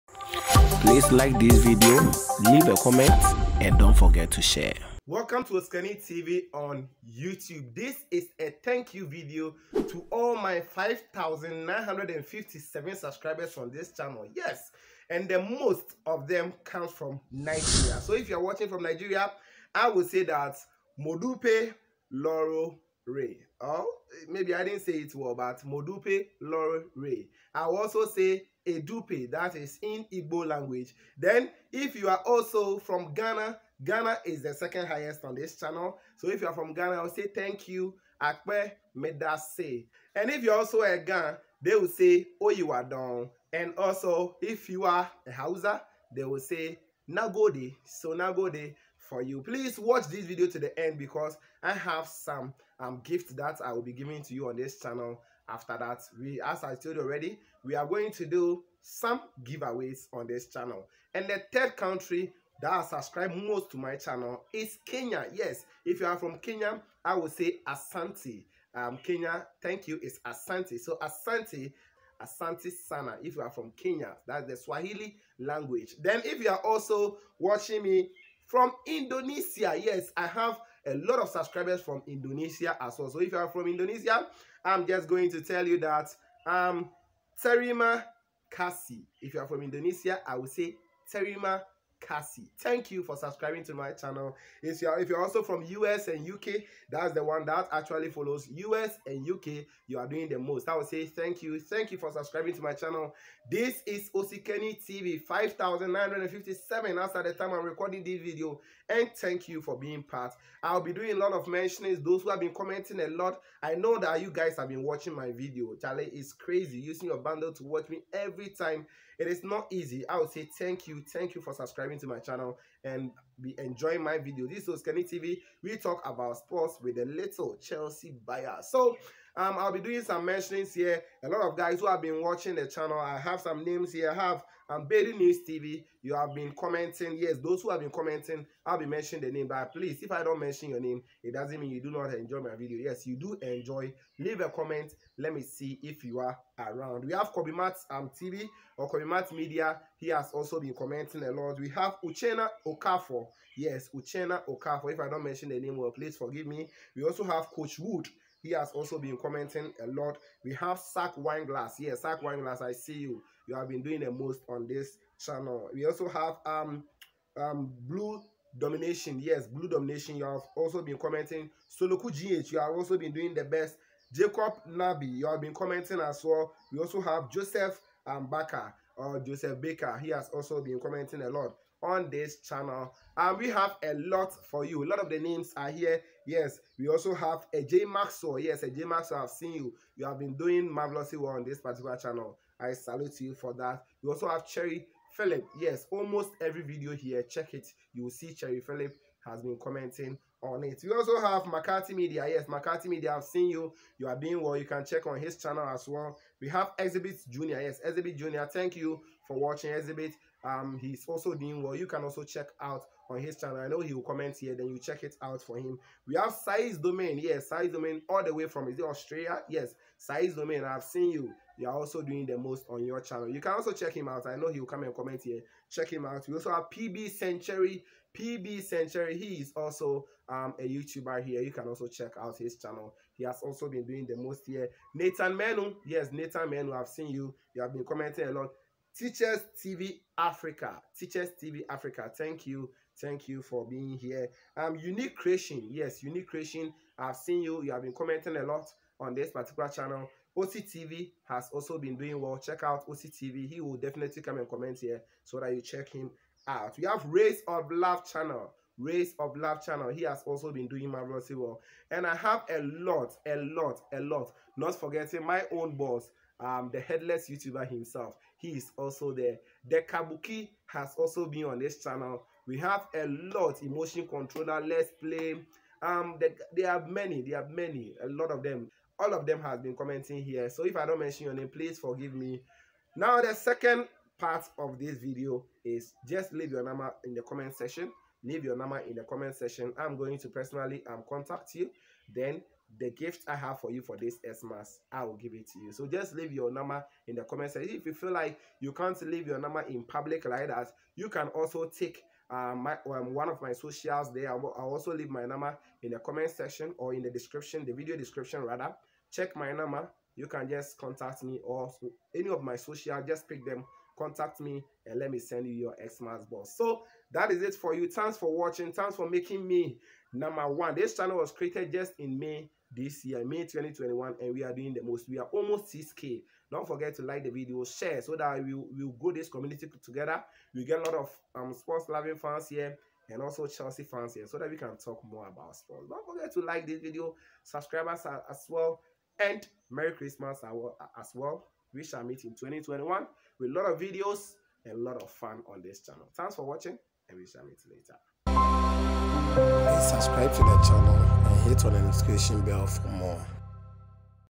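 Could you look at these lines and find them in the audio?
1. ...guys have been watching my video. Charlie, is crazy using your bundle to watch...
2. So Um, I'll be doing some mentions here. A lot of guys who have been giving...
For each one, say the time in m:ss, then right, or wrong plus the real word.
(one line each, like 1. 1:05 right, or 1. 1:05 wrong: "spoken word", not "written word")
1. 1:54 right
2. 2:08 wrong: "watching", not "giving".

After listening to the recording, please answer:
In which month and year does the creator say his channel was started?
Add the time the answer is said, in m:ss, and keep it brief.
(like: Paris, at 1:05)
May 2021, at 5:23.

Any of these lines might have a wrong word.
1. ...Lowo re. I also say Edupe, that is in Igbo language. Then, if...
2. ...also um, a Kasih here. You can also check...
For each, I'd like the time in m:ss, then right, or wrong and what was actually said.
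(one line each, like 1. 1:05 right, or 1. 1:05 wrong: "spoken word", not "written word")
1. 0:26 right
2. 3:49 wrong: "YouTuber", not "Kasih".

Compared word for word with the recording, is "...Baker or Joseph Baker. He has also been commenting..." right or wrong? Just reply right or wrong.
right.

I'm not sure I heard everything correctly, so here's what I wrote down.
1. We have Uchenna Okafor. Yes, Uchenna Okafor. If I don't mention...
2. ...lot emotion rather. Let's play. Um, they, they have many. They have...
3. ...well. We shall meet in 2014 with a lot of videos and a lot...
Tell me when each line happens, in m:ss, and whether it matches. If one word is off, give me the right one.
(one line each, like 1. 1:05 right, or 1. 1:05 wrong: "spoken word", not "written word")
1. 2:31 right
2. 4:33 wrong: "controller", not "rather"
3. 5:41 wrong: "2021", not "2014".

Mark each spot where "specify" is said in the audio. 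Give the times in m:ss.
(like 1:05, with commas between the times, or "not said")
not said.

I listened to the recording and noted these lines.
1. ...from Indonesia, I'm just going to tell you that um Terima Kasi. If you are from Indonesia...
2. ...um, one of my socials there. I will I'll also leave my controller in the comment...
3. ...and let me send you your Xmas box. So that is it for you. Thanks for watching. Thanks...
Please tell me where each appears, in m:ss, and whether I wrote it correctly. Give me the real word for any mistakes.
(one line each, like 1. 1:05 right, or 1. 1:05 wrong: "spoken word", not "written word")
1. 1:23 right
2. 5:02 wrong: "number", not "controller"
3. 5:14 right.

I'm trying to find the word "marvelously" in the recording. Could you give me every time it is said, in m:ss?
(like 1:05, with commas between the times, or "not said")
3:10, 4:20.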